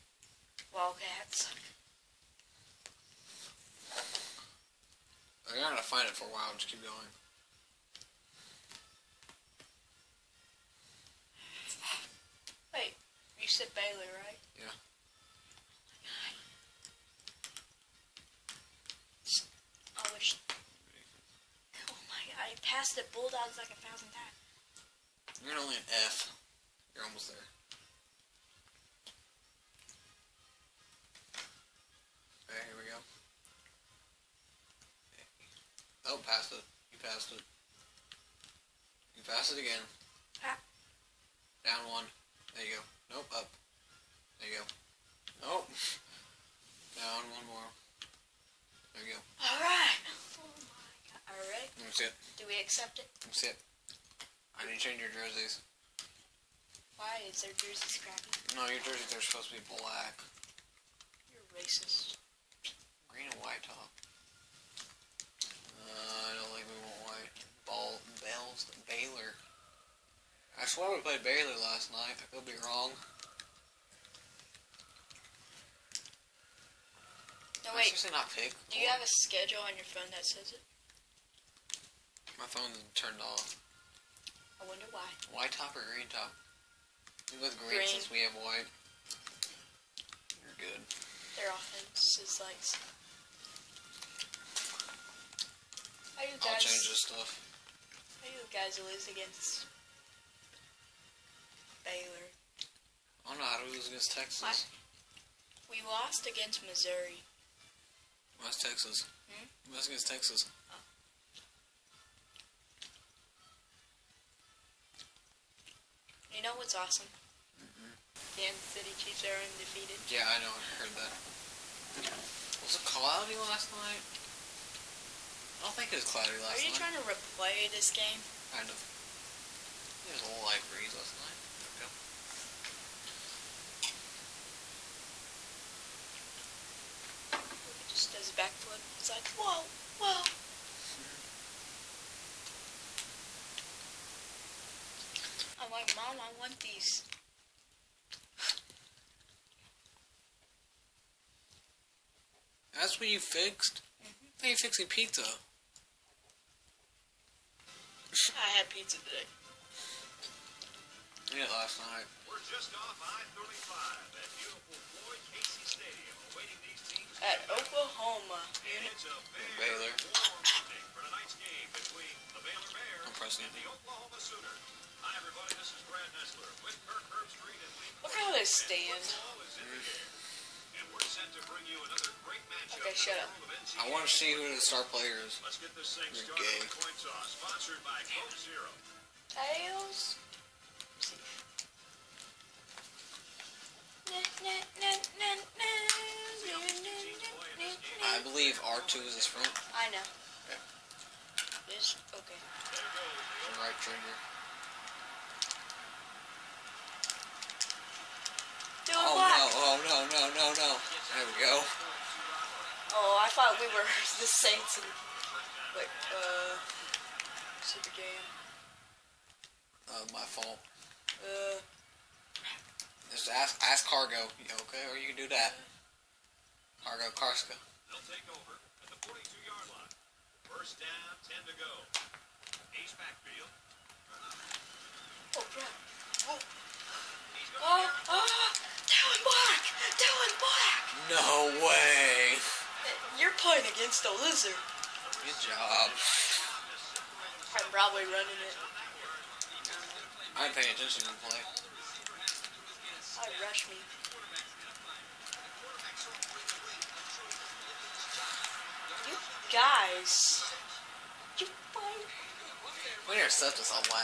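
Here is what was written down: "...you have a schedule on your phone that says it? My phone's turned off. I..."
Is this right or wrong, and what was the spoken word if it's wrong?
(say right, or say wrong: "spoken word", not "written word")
right.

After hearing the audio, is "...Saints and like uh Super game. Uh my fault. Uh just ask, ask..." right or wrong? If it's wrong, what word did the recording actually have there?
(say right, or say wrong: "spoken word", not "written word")
right.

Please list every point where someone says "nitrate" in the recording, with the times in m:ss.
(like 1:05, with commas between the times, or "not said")
not said.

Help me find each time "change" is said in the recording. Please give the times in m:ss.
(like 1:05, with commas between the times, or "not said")
0:54, 1:36.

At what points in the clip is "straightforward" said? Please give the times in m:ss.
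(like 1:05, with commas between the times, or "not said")
not said.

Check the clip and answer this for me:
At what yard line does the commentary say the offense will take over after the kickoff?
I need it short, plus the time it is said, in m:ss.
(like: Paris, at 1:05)
42-yard line, at 3:49.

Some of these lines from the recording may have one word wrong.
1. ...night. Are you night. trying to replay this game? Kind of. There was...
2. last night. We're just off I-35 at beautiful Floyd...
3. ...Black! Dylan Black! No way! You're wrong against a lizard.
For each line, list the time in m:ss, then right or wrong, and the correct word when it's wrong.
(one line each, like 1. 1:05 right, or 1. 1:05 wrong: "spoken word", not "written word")
1. 2:06 right
2. 2:41 right
3. 3:59 wrong: "playing", not "wrong".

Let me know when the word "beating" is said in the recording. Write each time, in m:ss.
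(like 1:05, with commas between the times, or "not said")
not said.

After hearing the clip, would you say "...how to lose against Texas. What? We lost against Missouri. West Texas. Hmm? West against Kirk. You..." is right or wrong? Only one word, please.
wrong.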